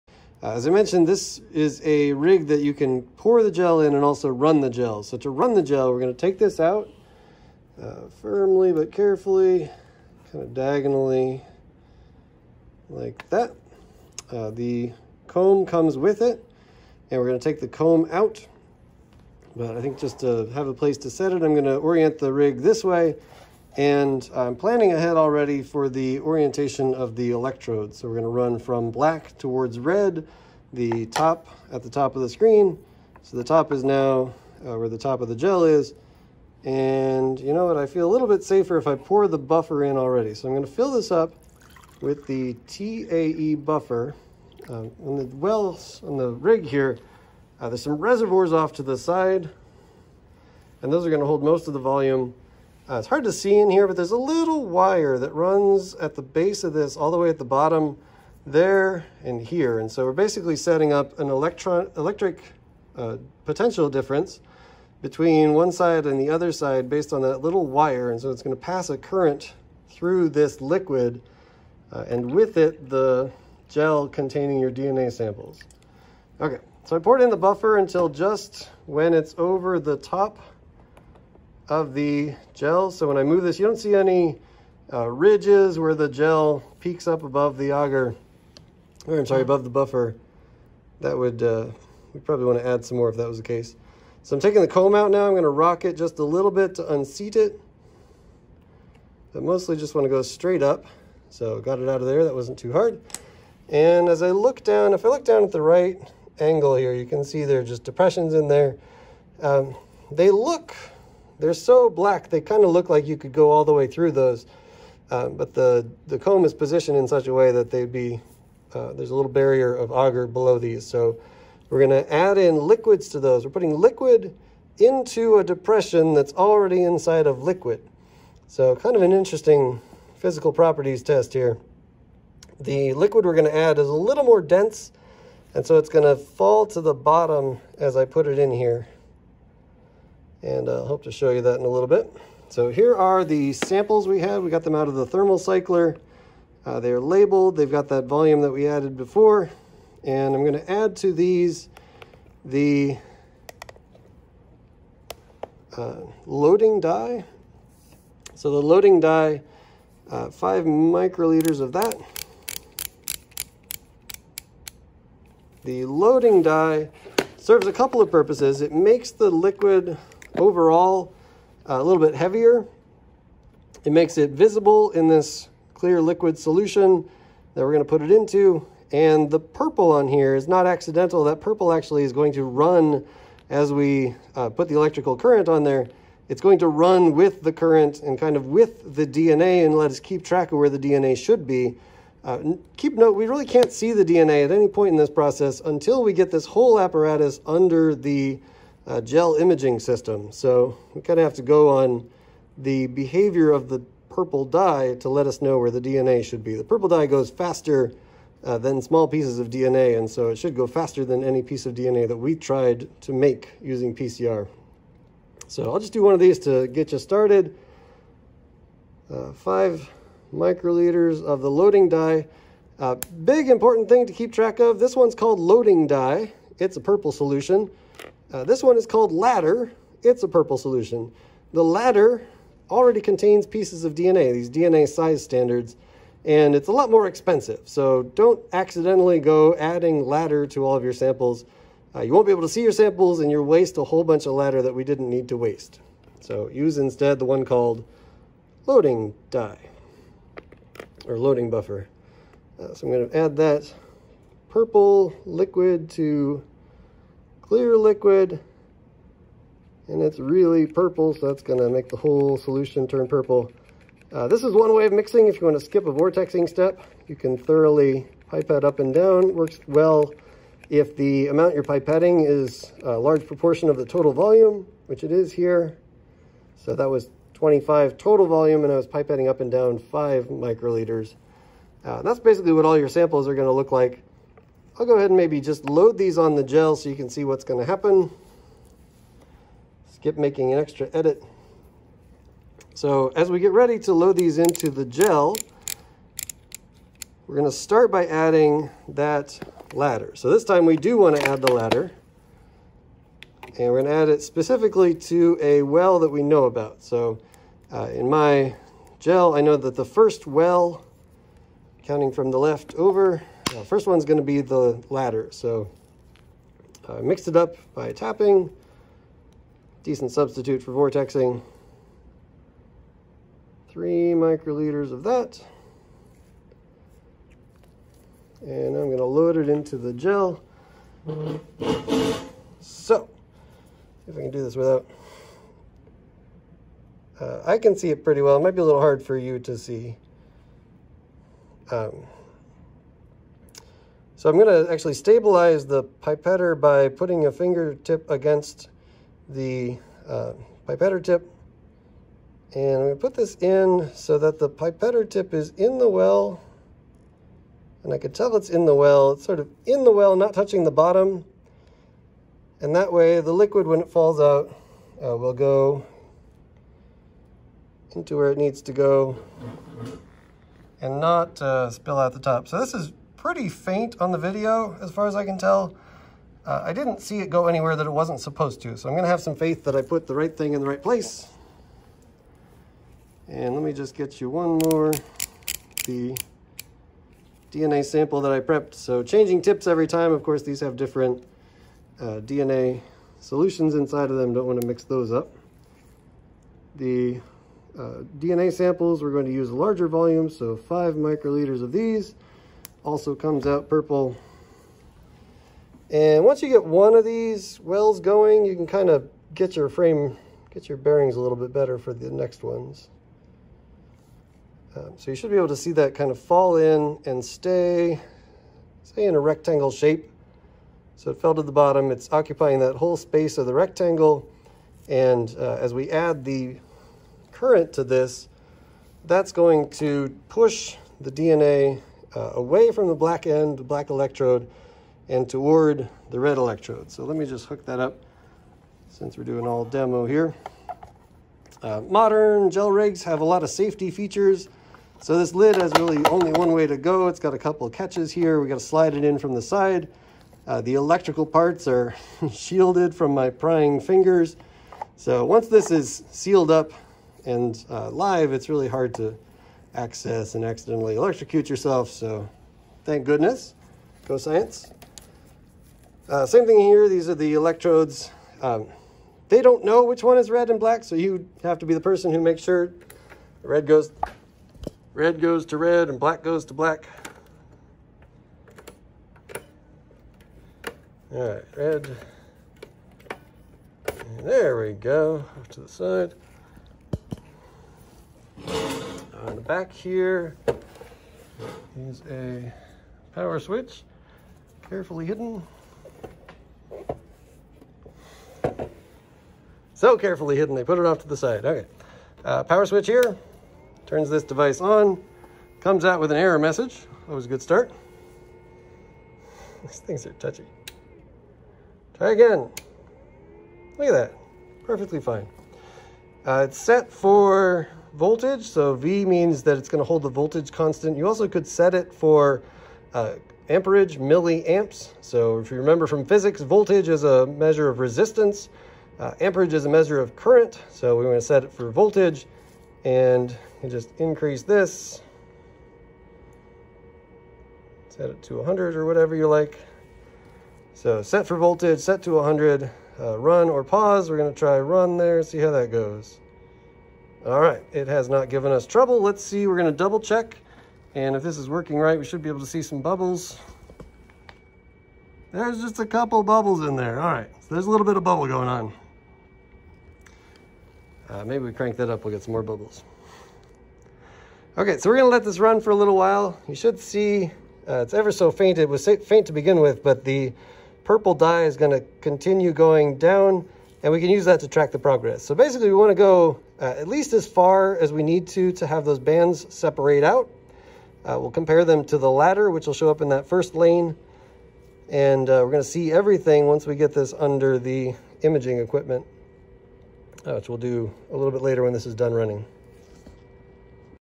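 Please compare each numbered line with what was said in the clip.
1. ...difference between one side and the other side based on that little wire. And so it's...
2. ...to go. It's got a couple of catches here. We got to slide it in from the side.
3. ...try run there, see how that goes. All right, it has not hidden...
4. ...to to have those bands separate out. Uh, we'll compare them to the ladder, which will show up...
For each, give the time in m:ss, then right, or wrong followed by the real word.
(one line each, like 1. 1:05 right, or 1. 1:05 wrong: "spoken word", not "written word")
1. 1:03 right
2. 7:26 right
3. 9:04 wrong: "given", not "hidden"
4. 9:38 right.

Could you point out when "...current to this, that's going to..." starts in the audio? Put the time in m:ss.
7:07.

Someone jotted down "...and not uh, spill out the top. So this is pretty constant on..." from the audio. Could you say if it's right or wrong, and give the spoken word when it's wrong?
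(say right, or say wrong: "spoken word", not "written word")
wrong: "faint", not "constant".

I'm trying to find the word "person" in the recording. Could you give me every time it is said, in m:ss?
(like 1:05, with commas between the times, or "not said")
7:51.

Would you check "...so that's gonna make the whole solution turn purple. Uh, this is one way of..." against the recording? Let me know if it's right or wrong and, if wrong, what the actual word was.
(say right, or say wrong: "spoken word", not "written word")
right.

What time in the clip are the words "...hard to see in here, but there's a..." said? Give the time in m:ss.
0:53.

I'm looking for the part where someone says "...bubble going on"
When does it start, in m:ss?
9:18.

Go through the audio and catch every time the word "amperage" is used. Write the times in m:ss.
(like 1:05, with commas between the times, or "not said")
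8:43, 8:49.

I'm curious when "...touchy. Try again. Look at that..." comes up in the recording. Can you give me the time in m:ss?
8:30.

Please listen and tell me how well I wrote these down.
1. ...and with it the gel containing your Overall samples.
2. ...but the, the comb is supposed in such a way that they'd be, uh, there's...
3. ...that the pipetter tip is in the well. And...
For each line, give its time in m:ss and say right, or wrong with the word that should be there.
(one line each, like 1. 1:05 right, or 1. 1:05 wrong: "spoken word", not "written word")
1. 1:12 wrong: "DNA", not "Overall"
2. 1:55 wrong: "positioned", not "supposed"
3. 5:54 right.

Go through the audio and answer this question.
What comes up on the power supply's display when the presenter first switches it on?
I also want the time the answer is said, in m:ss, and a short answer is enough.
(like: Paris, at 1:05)
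an error message, at 8:26.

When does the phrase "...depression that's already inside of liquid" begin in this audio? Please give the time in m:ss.
2:05.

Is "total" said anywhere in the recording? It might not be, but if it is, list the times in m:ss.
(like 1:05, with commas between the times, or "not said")
4:33, 4:37.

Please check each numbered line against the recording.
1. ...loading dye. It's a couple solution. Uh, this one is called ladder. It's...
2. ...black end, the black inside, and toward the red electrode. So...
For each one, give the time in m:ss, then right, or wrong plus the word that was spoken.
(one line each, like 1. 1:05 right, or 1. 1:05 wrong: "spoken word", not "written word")
1. 3:45 wrong: "purple", not "couple"
2. 7:12 wrong: "electrode", not "inside".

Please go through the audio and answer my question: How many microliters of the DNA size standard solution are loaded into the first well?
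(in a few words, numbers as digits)
3.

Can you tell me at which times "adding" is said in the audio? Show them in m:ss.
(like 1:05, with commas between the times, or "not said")
3:59, 4:58.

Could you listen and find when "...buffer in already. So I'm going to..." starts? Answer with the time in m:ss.
0:39.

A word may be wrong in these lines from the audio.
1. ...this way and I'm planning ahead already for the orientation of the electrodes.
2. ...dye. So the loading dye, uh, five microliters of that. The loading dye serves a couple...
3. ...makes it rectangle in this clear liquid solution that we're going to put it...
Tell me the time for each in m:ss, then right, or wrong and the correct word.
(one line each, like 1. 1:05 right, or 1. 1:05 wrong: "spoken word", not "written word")
1. 0:22 right
2. 2:36 right
3. 2:53 wrong: "visible", not "rectangle".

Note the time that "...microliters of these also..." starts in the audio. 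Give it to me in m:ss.
6:40.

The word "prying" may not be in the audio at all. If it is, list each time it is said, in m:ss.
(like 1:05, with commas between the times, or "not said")
7:33.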